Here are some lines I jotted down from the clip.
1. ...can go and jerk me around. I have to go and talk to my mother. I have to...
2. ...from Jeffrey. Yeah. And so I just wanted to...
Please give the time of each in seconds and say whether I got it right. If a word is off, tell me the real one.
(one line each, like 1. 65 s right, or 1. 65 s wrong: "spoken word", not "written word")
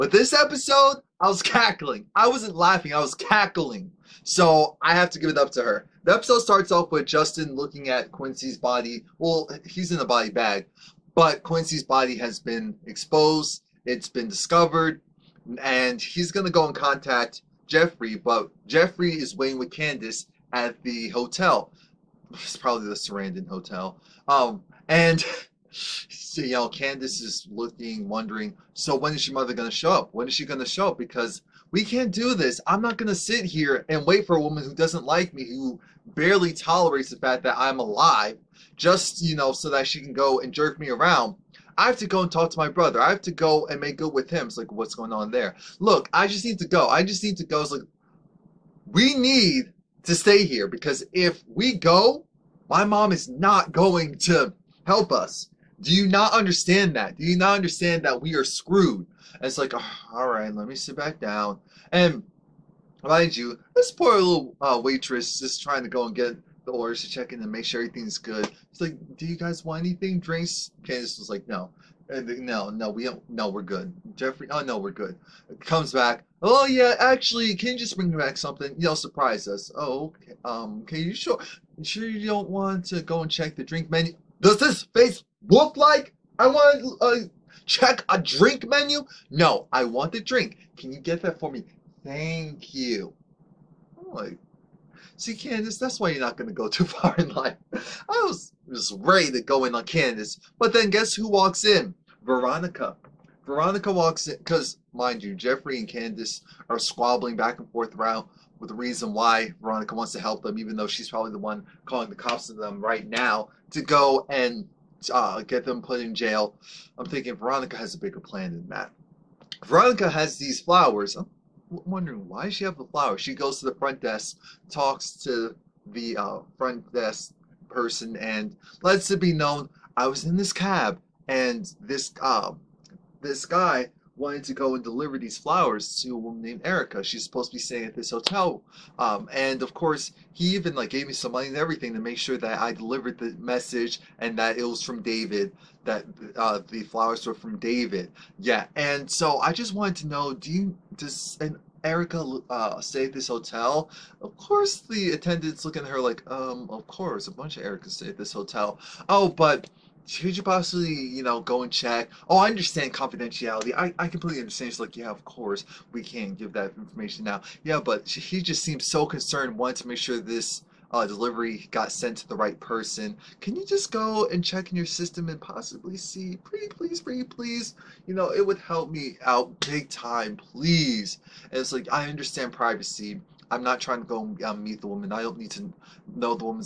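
1. 40 s wrong: "brother", not "mother"
2. 147 s wrong: "David", not "Jeffrey".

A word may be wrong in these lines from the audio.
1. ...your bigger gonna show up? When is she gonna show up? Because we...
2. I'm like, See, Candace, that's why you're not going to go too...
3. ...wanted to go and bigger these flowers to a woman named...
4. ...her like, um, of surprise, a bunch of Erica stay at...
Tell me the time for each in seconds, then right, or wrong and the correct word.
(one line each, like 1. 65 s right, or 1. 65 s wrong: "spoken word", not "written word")
1. 29 s wrong: "mother", not "bigger"
2. 93 s right
3. 134 s wrong: "deliver", not "bigger"
4. 155 s wrong: "course", not "surprise".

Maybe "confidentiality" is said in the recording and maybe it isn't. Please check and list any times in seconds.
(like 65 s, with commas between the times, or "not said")
162 s.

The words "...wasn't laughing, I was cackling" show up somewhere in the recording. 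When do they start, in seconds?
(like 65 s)
2 s.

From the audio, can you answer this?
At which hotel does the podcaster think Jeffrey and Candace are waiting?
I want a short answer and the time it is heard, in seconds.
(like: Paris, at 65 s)
Sarandon Hotel, at 22 s.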